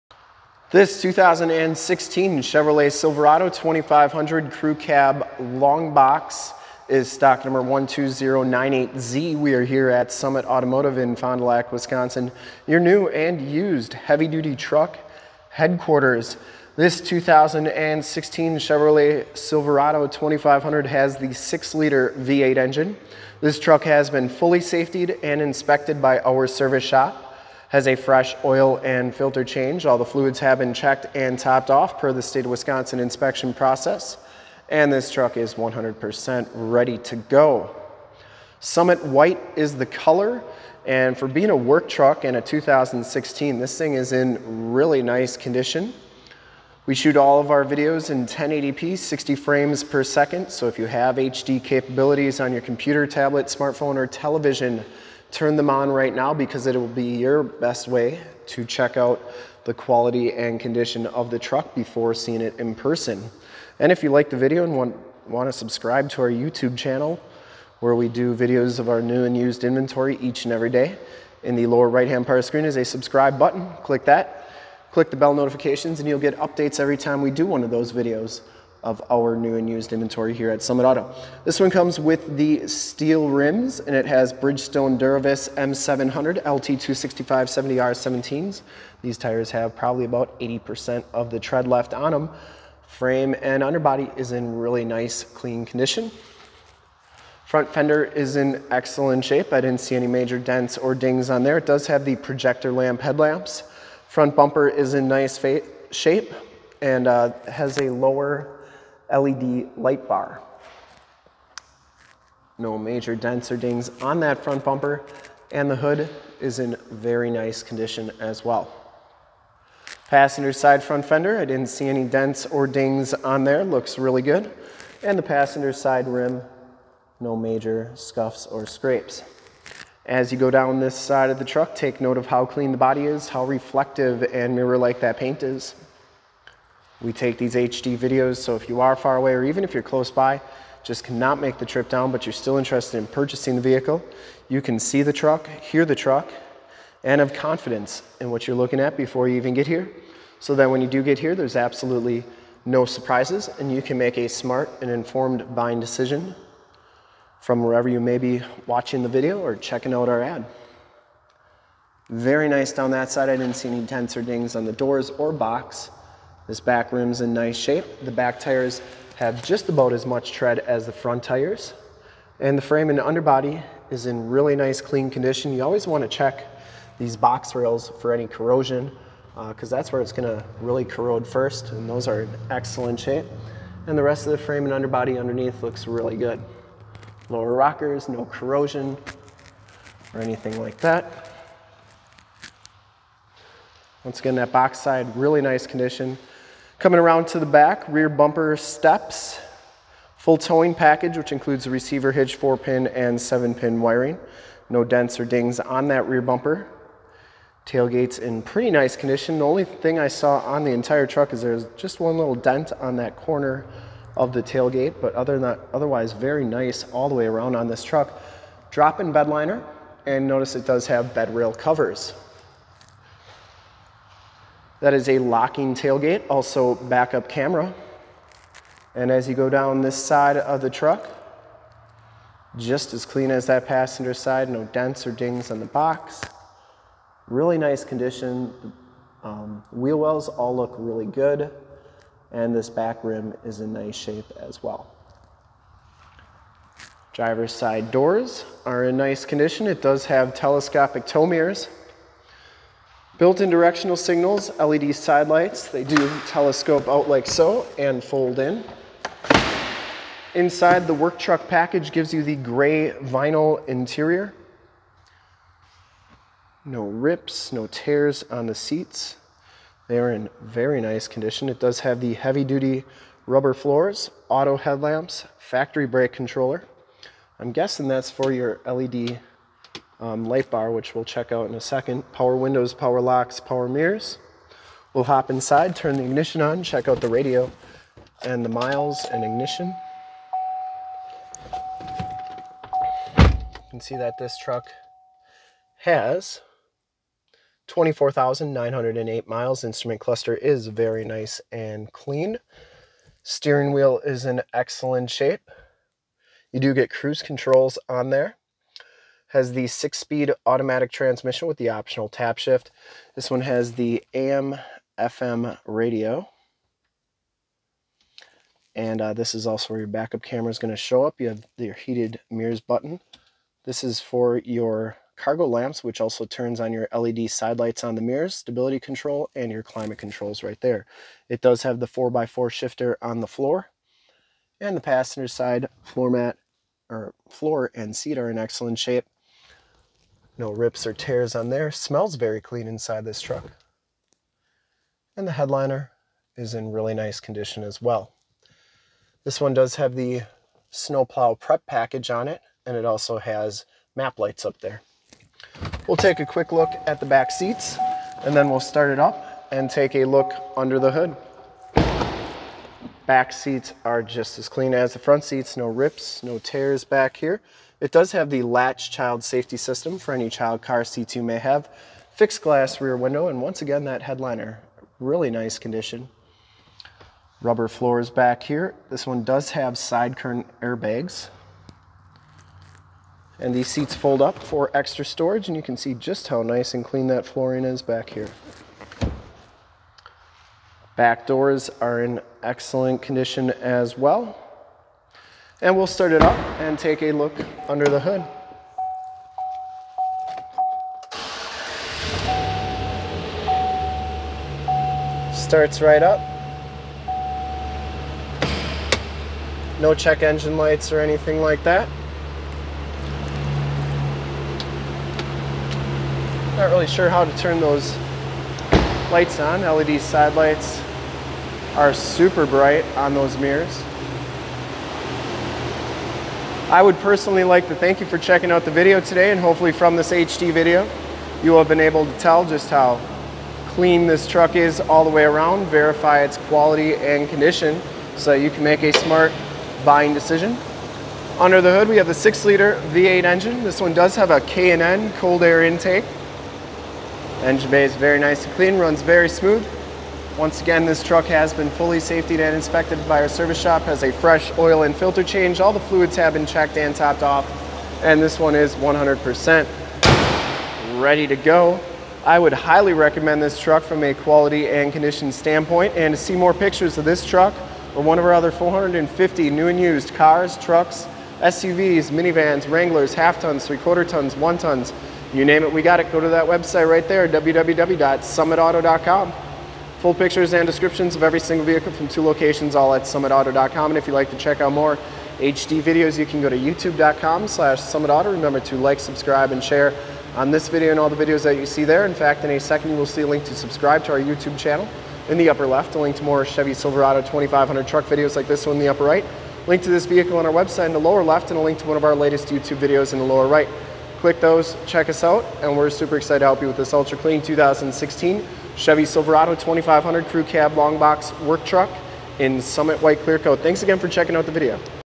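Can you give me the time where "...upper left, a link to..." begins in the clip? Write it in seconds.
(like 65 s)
495 s.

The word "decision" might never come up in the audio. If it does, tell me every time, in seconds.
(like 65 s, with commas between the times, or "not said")
155 s, 440 s.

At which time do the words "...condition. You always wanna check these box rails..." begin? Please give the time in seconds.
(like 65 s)
175 s.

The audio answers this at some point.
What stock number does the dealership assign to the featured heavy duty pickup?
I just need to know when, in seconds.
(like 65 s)
7 s.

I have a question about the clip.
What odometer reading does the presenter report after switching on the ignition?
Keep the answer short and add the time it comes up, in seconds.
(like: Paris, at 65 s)
24,908 miles, at 297 s.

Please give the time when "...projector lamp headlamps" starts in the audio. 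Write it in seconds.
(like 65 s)
102 s.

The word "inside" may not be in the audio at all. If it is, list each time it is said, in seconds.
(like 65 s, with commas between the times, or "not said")
260 s, 285 s, 342 s.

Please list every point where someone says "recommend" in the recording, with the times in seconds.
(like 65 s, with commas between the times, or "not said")
462 s.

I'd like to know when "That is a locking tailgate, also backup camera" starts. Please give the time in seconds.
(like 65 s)
224 s.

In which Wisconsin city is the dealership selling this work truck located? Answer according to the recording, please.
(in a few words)
Fond du Lac.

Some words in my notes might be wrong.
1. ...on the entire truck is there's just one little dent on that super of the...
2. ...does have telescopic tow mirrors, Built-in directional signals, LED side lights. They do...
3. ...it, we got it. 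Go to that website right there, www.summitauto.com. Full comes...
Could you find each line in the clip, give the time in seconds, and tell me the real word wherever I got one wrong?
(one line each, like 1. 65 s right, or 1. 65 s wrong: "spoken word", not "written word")
1. 210 s wrong: "corner", not "super"
2. 249 s right
3. 475 s wrong: "pictures", not "comes".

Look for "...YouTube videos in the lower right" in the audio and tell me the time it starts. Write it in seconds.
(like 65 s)
502 s.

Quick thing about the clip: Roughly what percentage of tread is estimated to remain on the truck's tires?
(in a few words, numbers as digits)
80%.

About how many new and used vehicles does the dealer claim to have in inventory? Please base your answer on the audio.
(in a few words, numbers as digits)
450.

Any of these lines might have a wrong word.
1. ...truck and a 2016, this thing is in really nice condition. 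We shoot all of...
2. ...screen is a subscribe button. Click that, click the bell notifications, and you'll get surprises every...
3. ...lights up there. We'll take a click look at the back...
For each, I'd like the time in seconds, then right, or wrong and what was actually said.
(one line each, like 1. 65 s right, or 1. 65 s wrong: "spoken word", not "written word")
1. 41 s right
2. 72 s wrong: "updates", not "surprises"
3. 354 s wrong: "quick", not "click".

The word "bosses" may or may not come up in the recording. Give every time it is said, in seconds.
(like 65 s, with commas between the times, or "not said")
not said.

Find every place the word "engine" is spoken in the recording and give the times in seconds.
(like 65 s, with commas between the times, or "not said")
22 s, 410 s, 443 s, 447 s.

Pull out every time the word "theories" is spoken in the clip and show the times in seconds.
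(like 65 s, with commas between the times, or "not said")
not said.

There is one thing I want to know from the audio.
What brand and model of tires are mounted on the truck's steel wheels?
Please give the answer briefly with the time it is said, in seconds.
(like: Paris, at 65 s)
Bridgestone Duravis M700, at 84 s.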